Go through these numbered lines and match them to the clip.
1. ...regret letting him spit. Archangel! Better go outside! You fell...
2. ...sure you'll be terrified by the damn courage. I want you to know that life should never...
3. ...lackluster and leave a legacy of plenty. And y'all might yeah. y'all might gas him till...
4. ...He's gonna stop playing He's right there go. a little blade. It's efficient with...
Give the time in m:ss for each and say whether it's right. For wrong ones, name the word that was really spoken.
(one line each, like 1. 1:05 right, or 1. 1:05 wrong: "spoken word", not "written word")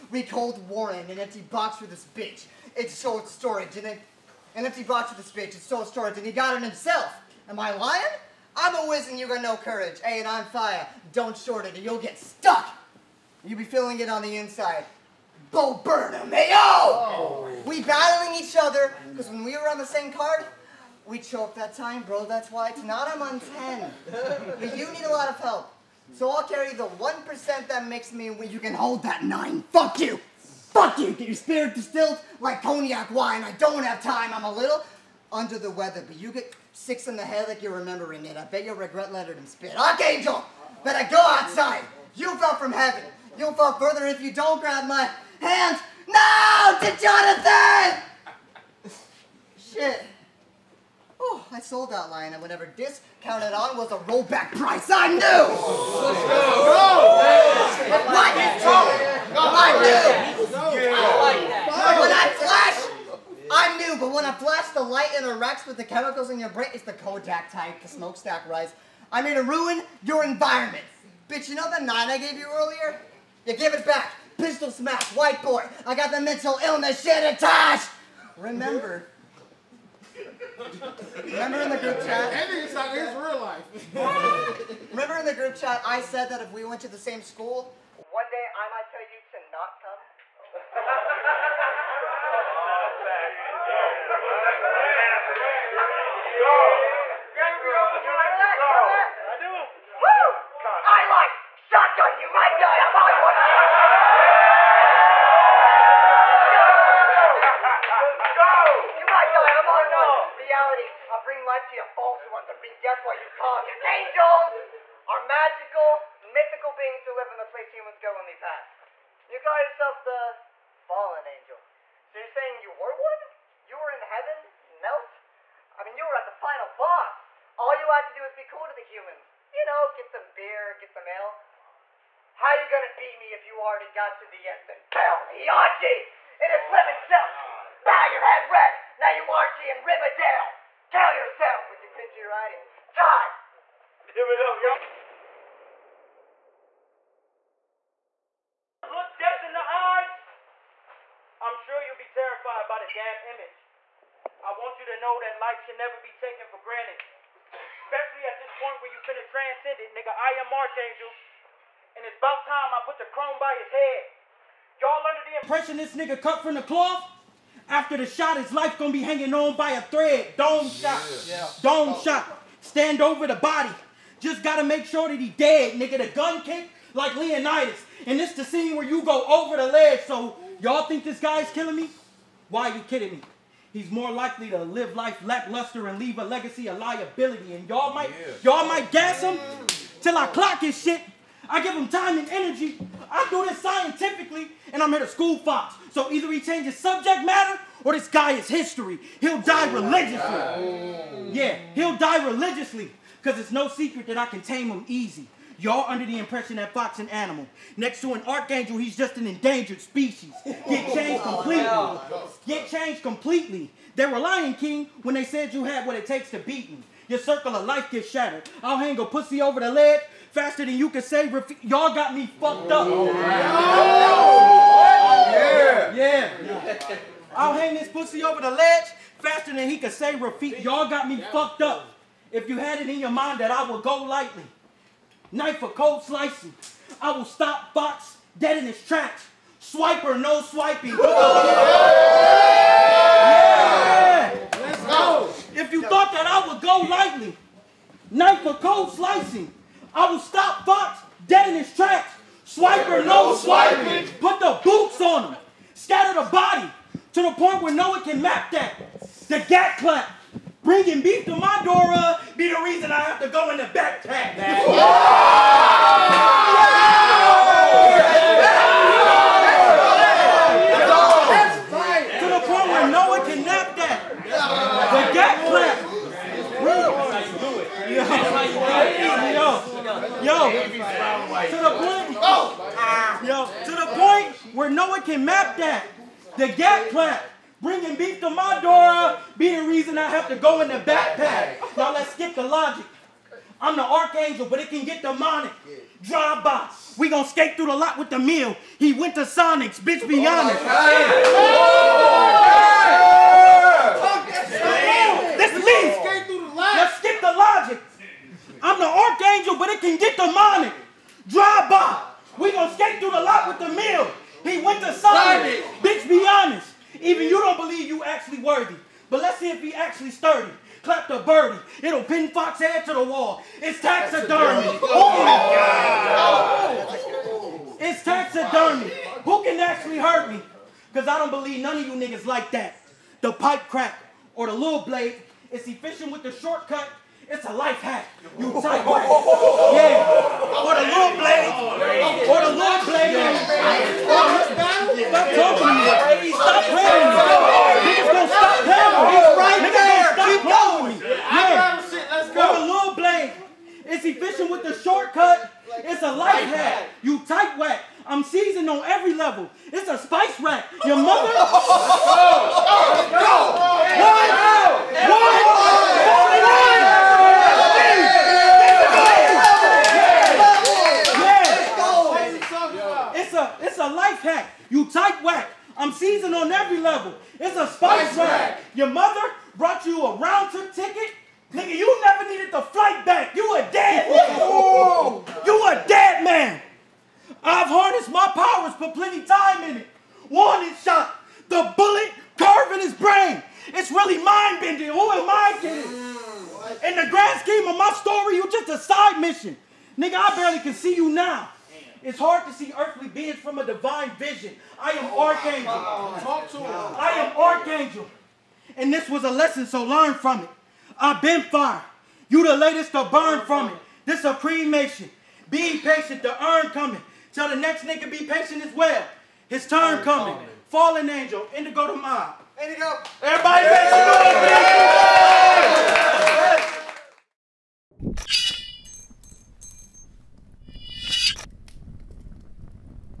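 1. 0:38 right
2. 2:31 wrong: "image", not "courage"
3. 3:05 wrong: "liability", not "plenty"
4. 5:46 right.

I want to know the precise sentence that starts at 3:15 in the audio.
So either he changes subject matter or this guy is history.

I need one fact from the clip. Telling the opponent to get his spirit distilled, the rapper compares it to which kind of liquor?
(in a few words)
Cognac.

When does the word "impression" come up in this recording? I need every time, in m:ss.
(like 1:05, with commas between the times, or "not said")
2:45, 3:26.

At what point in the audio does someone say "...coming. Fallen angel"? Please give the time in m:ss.
7:00.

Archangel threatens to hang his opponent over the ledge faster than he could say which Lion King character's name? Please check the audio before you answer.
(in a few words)
Rafiki.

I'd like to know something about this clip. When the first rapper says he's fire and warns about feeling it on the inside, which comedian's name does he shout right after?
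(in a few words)
Bo Burnham.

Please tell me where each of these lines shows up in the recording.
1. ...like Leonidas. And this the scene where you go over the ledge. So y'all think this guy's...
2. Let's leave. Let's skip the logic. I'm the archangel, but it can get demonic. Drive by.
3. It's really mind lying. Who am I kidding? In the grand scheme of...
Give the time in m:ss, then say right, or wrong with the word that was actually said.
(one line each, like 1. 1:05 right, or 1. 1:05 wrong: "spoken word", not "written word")
1. 2:56 right
2. 5:05 right
3. 6:33 wrong: "bending", not "lying".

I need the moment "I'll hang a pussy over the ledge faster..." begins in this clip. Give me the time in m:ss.
3:38.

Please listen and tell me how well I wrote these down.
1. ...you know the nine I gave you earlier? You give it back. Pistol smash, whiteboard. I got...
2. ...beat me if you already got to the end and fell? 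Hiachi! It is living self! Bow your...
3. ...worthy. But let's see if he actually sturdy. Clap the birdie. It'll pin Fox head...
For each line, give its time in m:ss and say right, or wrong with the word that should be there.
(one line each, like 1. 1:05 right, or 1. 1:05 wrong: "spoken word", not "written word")
1. 1:11 right
2. 2:12 right
3. 5:18 right.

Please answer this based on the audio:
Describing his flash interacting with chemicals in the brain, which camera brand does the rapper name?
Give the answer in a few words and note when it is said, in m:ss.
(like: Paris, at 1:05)
Kodak, at 1:06.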